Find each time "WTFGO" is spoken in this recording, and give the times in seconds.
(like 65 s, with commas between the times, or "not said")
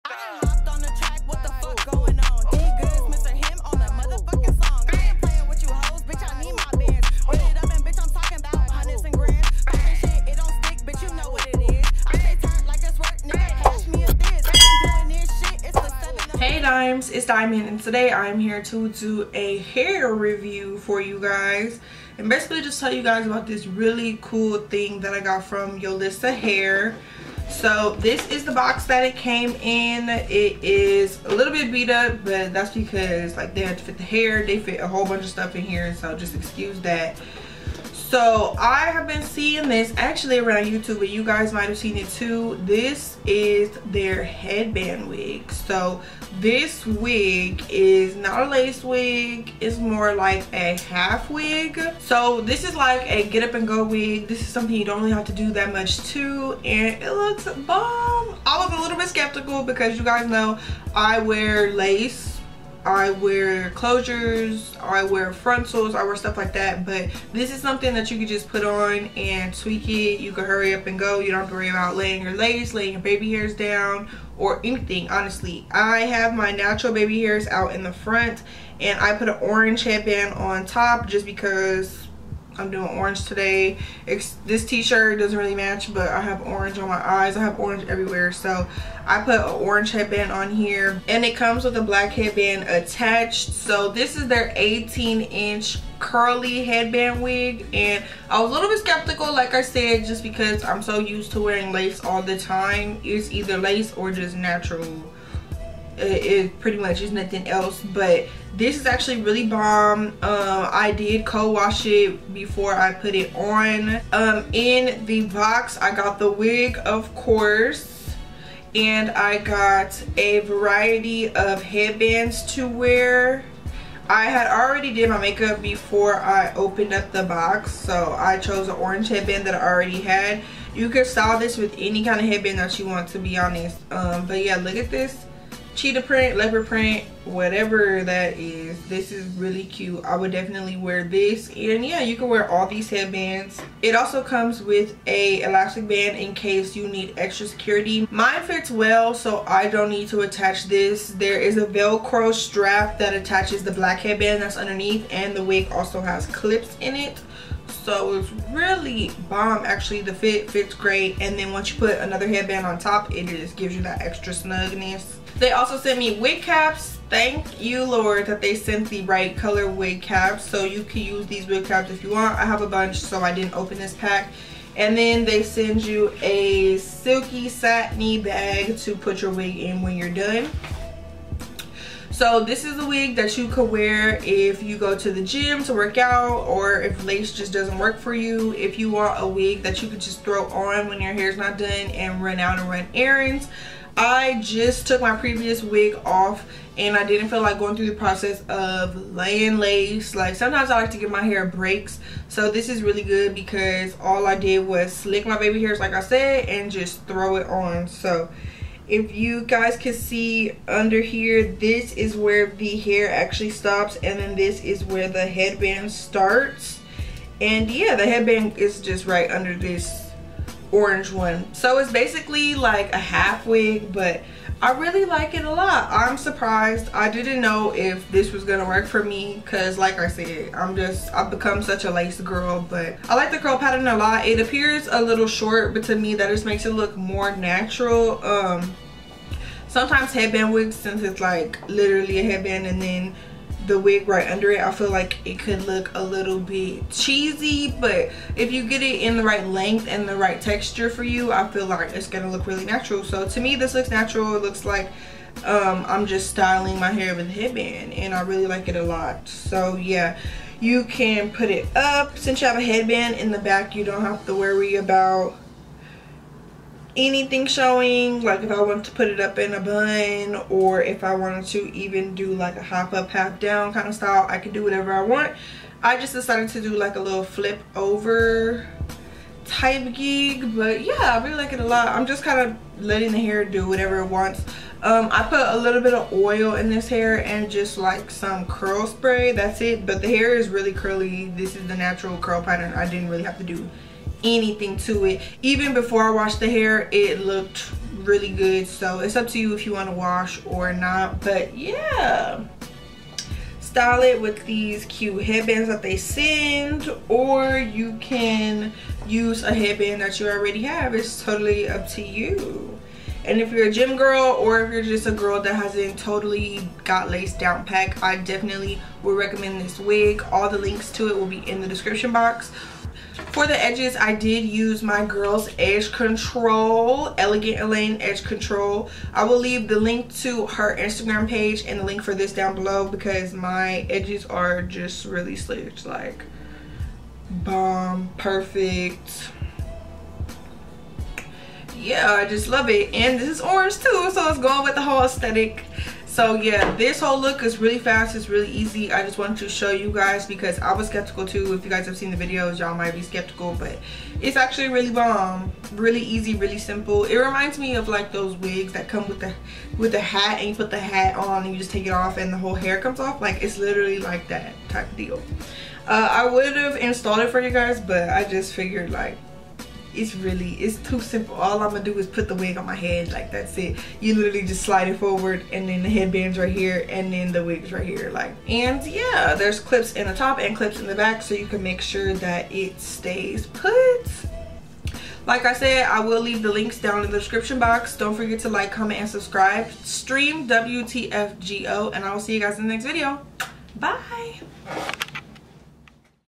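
390 s.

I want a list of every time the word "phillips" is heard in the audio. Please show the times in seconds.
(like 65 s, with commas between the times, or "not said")
not said.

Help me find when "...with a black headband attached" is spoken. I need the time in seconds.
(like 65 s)
91 s.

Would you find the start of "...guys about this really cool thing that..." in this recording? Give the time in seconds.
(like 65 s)
23 s.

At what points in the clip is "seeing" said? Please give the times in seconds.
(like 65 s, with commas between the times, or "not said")
39 s.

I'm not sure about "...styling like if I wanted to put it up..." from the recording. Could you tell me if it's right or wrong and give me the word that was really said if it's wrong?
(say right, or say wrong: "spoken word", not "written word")
wrong: "showing", not "styling".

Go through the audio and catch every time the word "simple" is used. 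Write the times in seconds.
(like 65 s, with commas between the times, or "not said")
356 s, 370 s.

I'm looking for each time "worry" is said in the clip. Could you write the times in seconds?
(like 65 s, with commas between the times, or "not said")
71 s, 264 s.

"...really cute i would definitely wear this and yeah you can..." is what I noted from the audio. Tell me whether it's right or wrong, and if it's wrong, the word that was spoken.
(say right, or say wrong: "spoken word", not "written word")
right.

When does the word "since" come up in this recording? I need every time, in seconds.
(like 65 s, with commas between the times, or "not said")
240 s, 262 s.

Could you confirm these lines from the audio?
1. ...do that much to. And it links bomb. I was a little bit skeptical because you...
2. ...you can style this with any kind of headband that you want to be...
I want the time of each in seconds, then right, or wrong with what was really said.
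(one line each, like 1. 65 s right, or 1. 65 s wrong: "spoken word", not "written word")
1. 55 s wrong: "looks", not "links"
2. 130 s right.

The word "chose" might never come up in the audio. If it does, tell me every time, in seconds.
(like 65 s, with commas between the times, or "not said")
128 s.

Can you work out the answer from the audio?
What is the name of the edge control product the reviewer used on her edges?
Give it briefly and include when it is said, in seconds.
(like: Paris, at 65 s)
Elegant Elaine Edge Control, at 327 s.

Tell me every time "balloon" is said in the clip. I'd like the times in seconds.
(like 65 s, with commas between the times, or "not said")
not said.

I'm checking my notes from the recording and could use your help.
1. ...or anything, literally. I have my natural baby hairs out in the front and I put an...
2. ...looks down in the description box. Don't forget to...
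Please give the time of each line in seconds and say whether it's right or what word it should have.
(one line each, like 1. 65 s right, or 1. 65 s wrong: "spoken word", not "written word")
1. 74 s wrong: "honestly", not "literally"
2. 386 s wrong: "links", not "looks".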